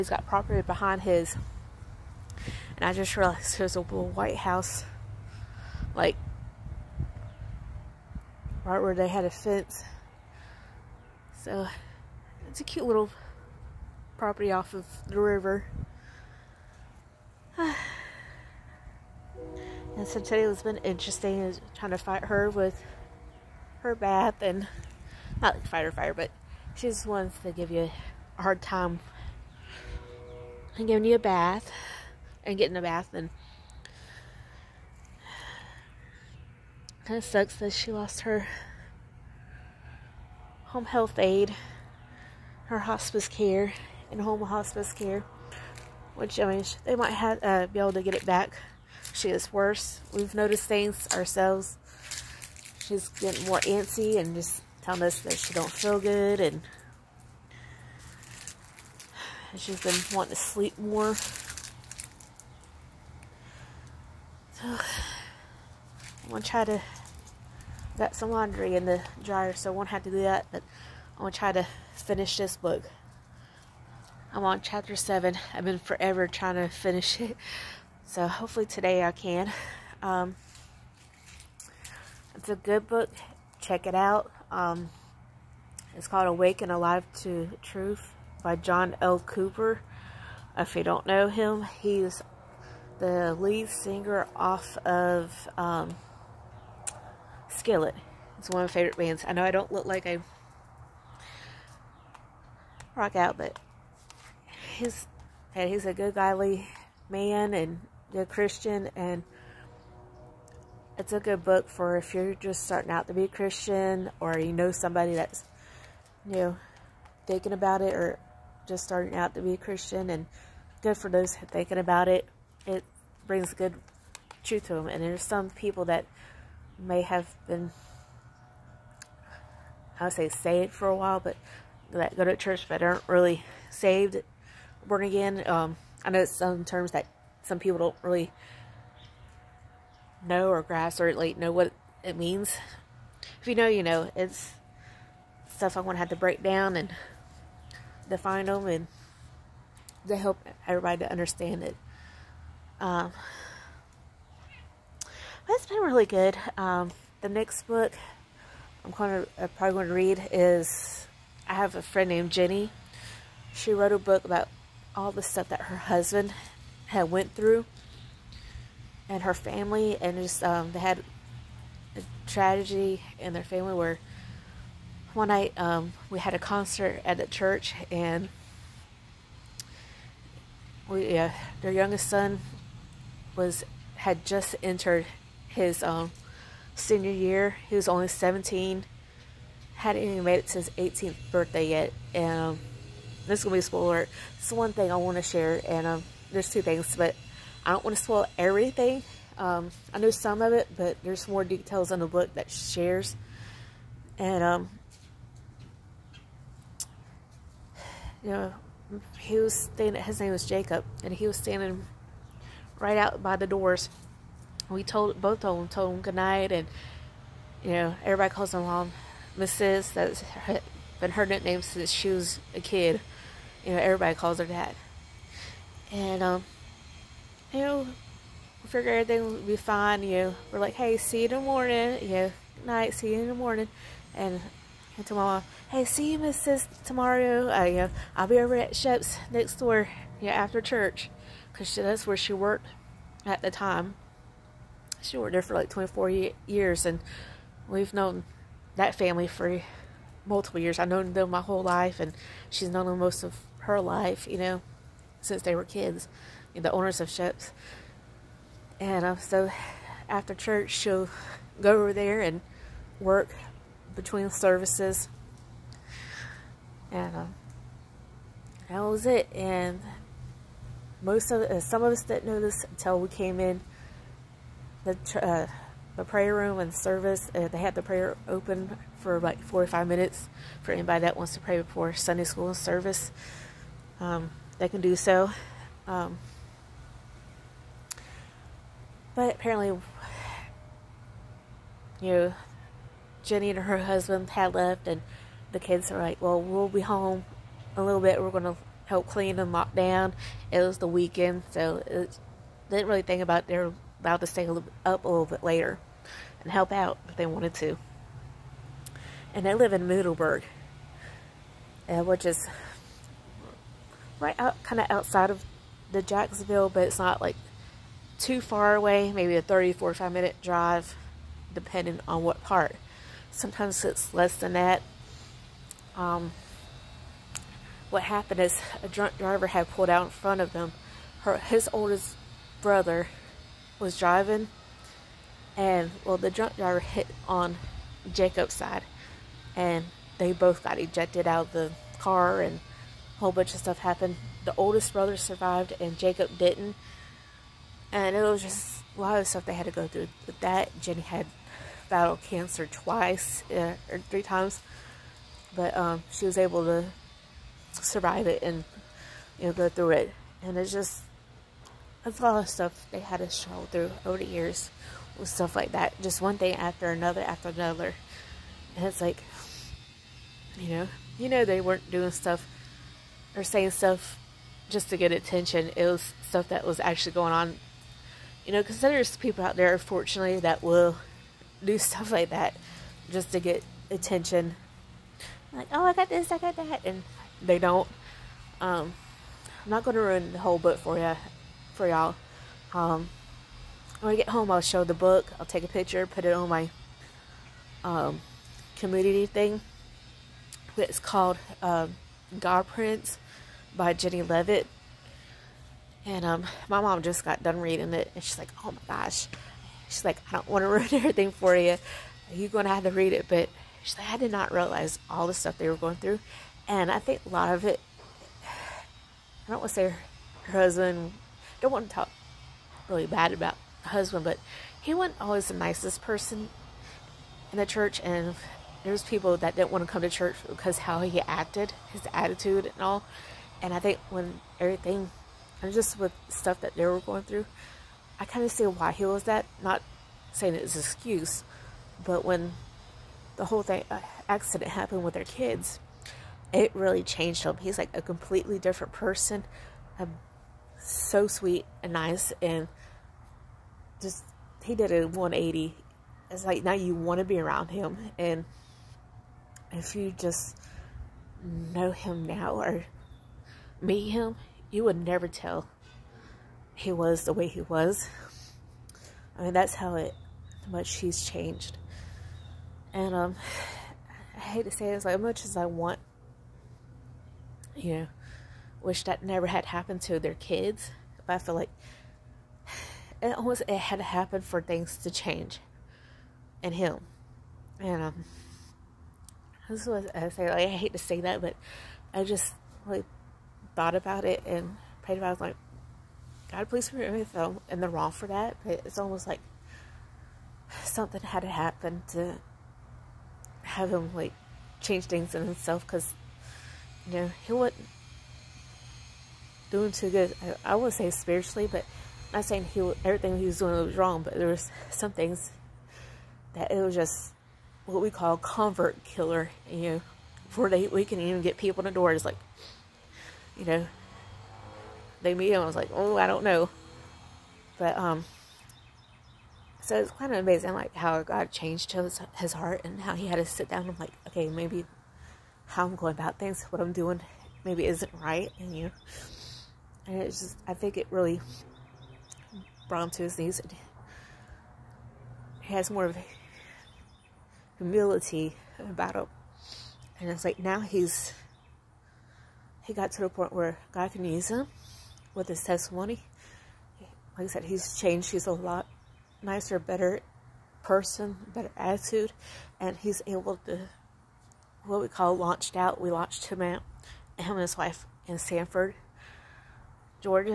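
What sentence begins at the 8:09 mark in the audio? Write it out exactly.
This was I say like I hate to say that, but I just like thought about it and prayed about it.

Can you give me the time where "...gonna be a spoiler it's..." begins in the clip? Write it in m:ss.
3:13.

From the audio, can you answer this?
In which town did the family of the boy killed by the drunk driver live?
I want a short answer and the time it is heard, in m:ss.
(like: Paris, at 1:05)
Middleburg, at 5:09.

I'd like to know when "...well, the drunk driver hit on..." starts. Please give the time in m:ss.
5:36.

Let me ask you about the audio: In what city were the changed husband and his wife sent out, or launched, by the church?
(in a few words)
Sanford.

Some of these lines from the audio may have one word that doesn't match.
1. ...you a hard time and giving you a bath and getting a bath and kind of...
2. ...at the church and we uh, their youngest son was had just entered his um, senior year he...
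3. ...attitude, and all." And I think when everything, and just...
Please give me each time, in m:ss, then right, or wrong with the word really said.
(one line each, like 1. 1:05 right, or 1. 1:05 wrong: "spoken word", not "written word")
1. 0:27 right
2. 2:57 right
3. 7:12 right.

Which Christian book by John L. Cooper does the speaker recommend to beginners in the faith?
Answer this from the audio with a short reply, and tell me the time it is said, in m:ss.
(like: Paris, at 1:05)
Awake and Alive to Truth, at 1:26.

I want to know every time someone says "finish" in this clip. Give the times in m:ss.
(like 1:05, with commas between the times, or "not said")
1:11, 1:16.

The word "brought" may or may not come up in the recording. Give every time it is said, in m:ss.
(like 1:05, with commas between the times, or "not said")
9:02.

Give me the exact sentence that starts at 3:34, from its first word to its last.
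We told, both of them told him goodnight, and, you know, everybody calls him mom, Mrs.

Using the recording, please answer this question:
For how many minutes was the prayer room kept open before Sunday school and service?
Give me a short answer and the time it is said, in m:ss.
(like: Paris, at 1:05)
45, at 4:39.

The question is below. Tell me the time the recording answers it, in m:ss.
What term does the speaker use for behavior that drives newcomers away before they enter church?
8:38.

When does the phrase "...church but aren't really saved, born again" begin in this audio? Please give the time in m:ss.
2:12.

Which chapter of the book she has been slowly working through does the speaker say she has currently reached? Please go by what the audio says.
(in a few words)
Chapter 7.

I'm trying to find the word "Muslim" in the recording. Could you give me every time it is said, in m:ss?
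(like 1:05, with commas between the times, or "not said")
not said.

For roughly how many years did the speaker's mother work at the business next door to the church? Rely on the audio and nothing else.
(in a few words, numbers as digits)
24.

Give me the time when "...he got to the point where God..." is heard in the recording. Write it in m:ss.
9:12.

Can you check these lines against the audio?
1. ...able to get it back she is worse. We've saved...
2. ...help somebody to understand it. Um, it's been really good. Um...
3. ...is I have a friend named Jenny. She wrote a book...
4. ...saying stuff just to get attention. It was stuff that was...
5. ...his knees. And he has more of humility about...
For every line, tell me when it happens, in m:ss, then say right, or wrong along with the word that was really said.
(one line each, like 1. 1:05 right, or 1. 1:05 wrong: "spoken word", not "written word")
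1. 0:47 wrong: "noticed", not "saved"
2. 2:30 wrong: "everybody", not "somebody"
3. 2:40 right
4. 6:13 right
5. 9:03 right.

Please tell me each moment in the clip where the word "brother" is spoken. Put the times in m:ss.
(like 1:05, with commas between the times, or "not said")
5:32, 5:44.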